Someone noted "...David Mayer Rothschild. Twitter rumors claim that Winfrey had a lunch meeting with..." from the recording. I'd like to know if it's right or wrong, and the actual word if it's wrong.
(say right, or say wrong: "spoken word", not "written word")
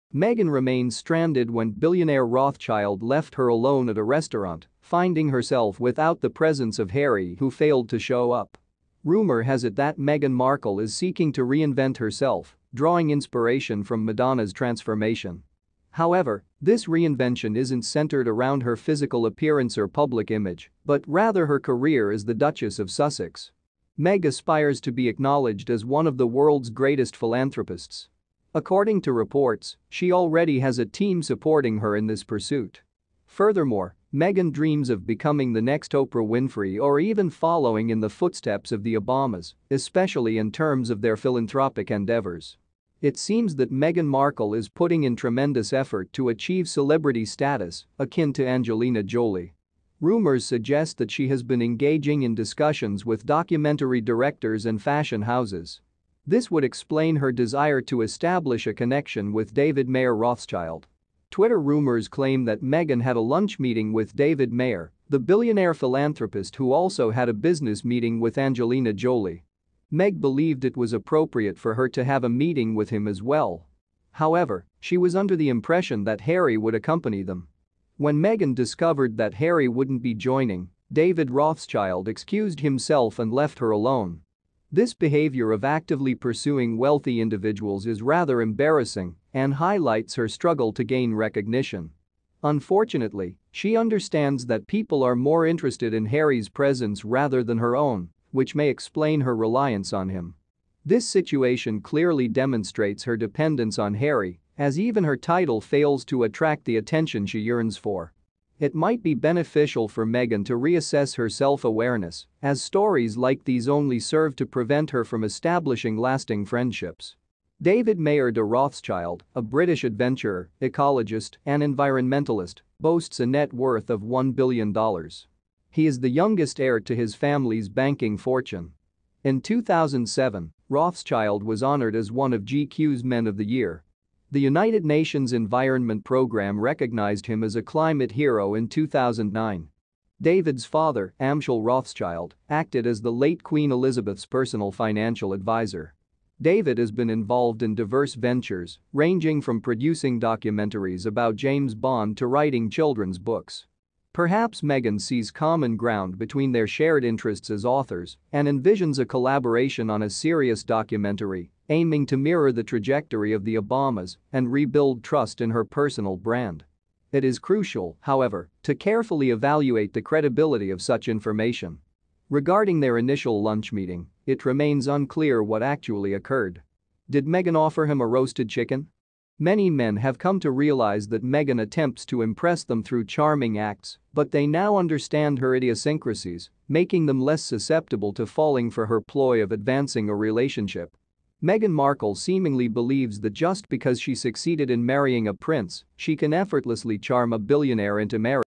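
wrong: "Meghan", not "Winfrey".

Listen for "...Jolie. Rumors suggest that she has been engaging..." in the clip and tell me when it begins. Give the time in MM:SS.
00:49.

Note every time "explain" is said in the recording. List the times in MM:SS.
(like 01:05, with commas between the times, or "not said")
00:56, 01:38.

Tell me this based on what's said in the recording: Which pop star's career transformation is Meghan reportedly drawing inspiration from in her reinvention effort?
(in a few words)
Madonna.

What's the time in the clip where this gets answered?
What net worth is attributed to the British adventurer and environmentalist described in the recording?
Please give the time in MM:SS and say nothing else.
02:04.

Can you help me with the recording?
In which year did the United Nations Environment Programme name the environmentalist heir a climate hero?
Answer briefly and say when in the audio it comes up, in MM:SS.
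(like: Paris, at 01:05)
2009, at 02:18.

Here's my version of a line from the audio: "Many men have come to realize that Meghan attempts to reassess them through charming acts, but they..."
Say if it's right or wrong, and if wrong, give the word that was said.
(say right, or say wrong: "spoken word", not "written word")
wrong: "impress", not "reassess".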